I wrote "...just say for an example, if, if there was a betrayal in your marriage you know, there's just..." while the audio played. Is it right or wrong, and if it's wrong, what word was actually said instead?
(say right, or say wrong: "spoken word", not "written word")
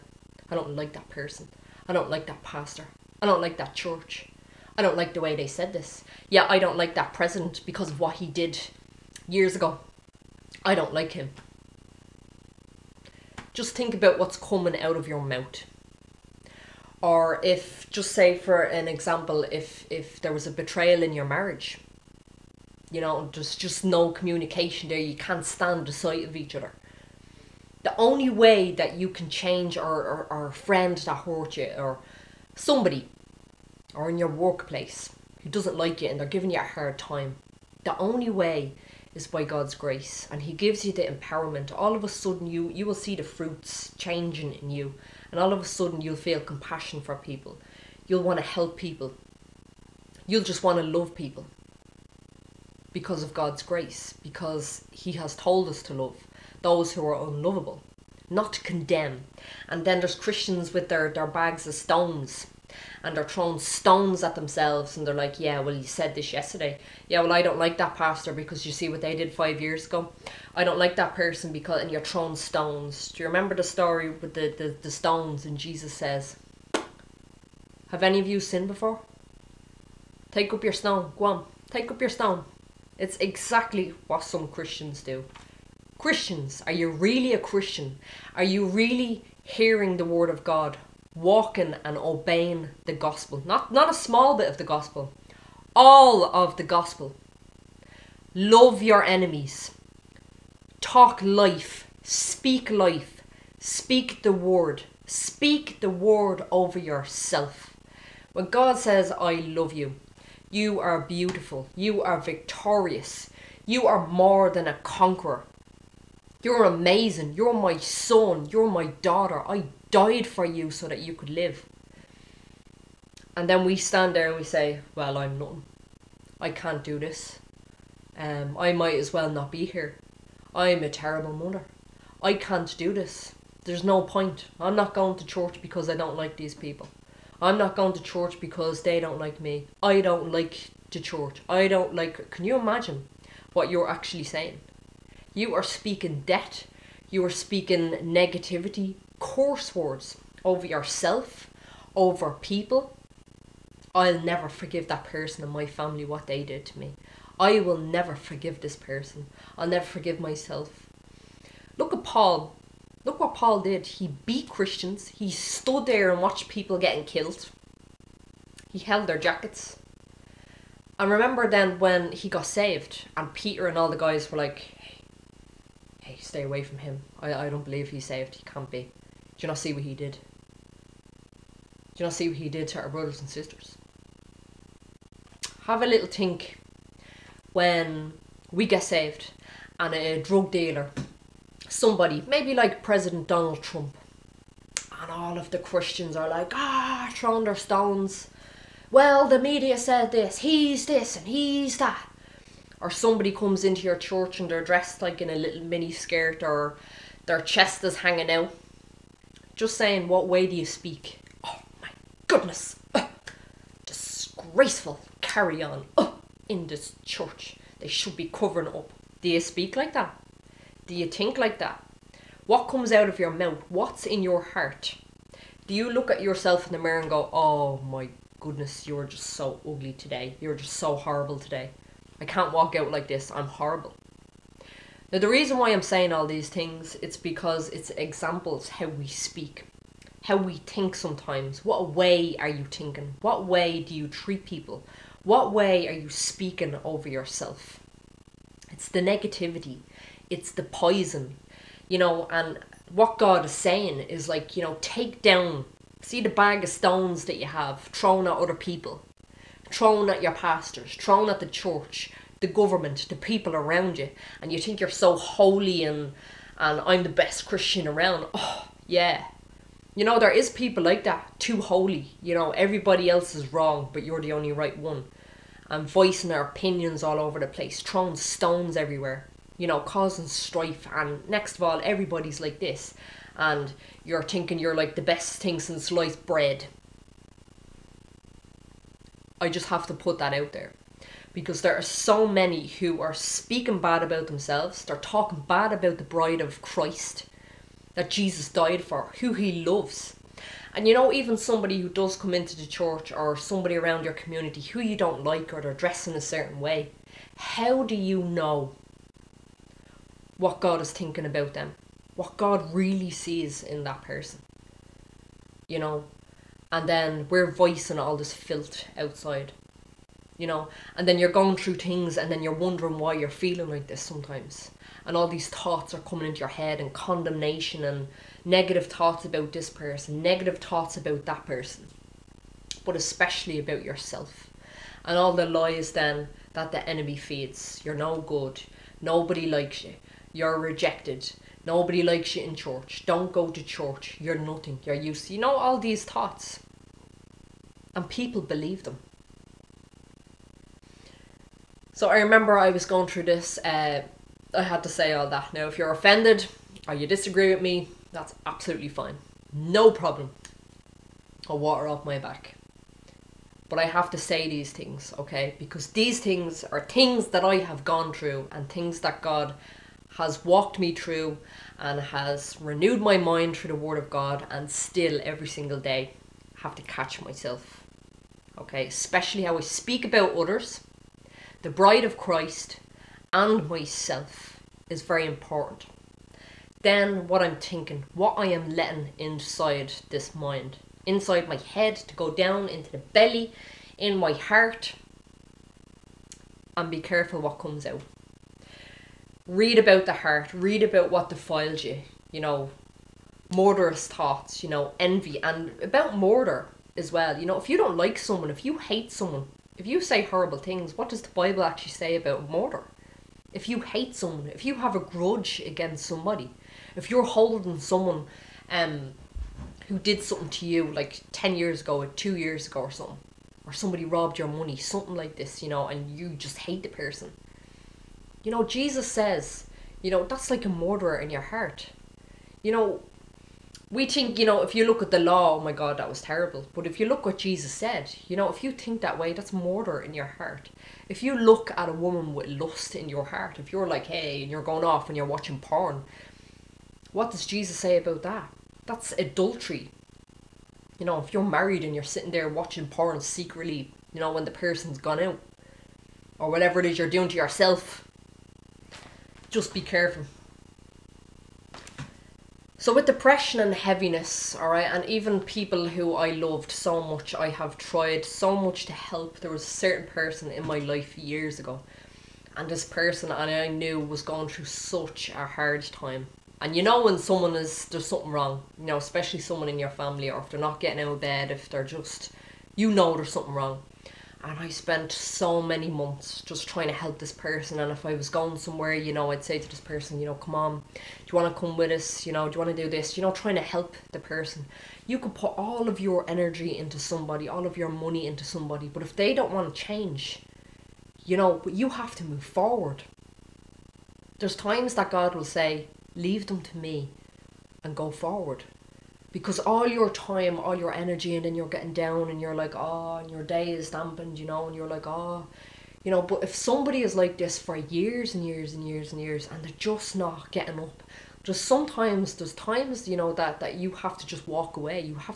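right.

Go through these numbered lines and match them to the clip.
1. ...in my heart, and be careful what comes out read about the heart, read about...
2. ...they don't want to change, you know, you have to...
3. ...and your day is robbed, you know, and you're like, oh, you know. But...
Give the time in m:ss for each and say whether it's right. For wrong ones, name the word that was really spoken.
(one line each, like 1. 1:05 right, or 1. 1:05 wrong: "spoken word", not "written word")
1. 6:33 right
2. 8:19 right
3. 8:33 wrong: "dampened", not "robbed".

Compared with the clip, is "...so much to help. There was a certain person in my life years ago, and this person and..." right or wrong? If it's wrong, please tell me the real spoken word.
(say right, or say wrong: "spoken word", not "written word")
right.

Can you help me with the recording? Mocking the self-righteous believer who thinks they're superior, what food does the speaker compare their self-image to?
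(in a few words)
sliced bread.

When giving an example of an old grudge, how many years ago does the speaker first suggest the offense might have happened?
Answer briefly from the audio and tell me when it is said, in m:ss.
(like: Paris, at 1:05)
10, at 7:01.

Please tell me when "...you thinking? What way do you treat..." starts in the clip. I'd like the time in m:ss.
4:02.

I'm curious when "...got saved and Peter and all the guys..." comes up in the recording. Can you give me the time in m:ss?
2:52.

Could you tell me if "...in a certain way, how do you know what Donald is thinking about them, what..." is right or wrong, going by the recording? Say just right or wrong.
wrong.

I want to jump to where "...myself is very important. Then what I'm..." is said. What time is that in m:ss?
6:23.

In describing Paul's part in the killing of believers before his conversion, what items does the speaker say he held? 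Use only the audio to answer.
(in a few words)
jackets.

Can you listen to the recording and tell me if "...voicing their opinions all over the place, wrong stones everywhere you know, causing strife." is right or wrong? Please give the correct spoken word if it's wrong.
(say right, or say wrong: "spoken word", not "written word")
wrong: "throwing", not "wrong".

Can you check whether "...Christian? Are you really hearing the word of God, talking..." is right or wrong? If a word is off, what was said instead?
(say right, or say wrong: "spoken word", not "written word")
wrong: "walking", not "talking".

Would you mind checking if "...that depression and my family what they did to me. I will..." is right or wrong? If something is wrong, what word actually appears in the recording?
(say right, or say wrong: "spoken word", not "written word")
wrong: "person", not "depression".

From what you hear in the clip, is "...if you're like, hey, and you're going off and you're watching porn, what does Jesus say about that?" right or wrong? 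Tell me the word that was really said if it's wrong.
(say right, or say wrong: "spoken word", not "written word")
right.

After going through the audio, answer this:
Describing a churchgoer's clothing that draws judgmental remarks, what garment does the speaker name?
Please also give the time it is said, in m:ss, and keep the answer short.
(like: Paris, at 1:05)
mini skirt, at 3:25.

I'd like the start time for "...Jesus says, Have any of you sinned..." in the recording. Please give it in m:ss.
1:15.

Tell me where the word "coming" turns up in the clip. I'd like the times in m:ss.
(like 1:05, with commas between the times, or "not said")
0:14, 5:25.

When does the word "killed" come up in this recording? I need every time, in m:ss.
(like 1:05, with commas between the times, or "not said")
2:47.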